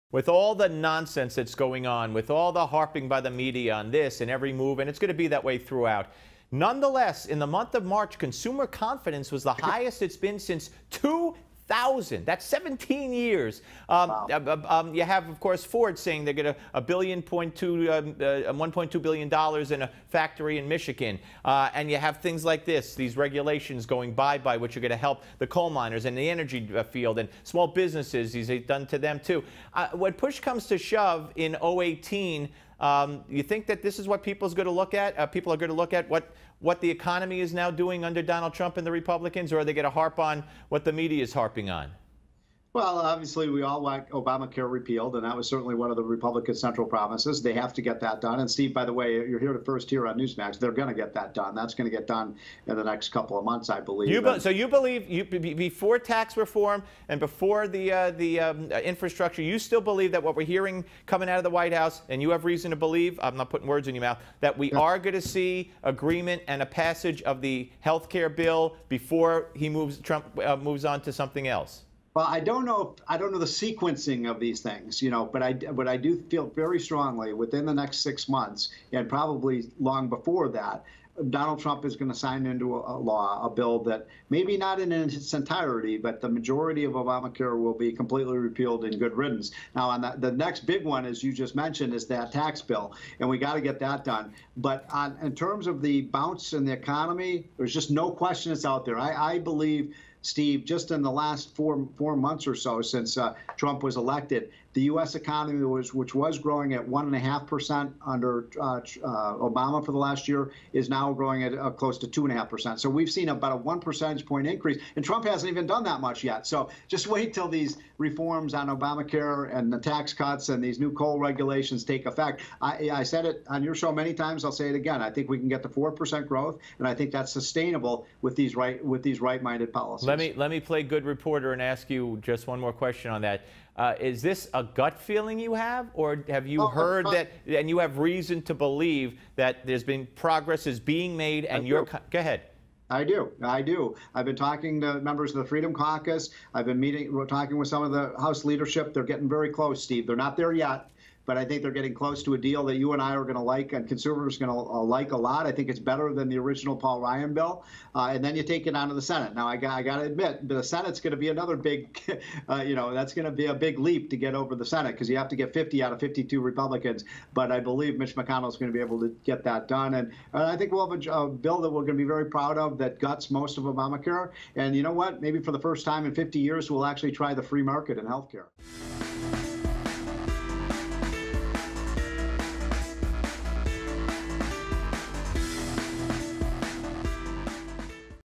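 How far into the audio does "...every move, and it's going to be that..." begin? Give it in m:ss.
0:04.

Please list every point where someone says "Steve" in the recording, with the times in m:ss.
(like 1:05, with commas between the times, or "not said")
0:48, 1:40, 2:29.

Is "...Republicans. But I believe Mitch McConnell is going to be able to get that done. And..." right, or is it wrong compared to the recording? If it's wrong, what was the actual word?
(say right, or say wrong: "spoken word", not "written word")
right.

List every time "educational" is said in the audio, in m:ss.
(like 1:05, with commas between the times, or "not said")
not said.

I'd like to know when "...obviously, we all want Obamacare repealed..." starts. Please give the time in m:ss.
0:42.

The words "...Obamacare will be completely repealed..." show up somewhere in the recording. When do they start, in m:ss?
1:26.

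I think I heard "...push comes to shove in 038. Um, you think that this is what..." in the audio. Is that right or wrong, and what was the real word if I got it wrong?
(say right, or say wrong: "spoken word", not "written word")
wrong: "018", not "038".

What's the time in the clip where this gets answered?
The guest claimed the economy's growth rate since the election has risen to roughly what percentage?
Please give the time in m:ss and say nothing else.
1:52.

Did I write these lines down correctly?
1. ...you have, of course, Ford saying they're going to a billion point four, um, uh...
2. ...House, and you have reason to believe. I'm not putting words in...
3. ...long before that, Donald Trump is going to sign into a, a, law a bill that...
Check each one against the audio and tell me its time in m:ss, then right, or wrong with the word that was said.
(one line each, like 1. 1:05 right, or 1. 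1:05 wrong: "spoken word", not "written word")
1. 0:14 wrong: "two", not "four"
2. 1:01 right
3. 1:19 right.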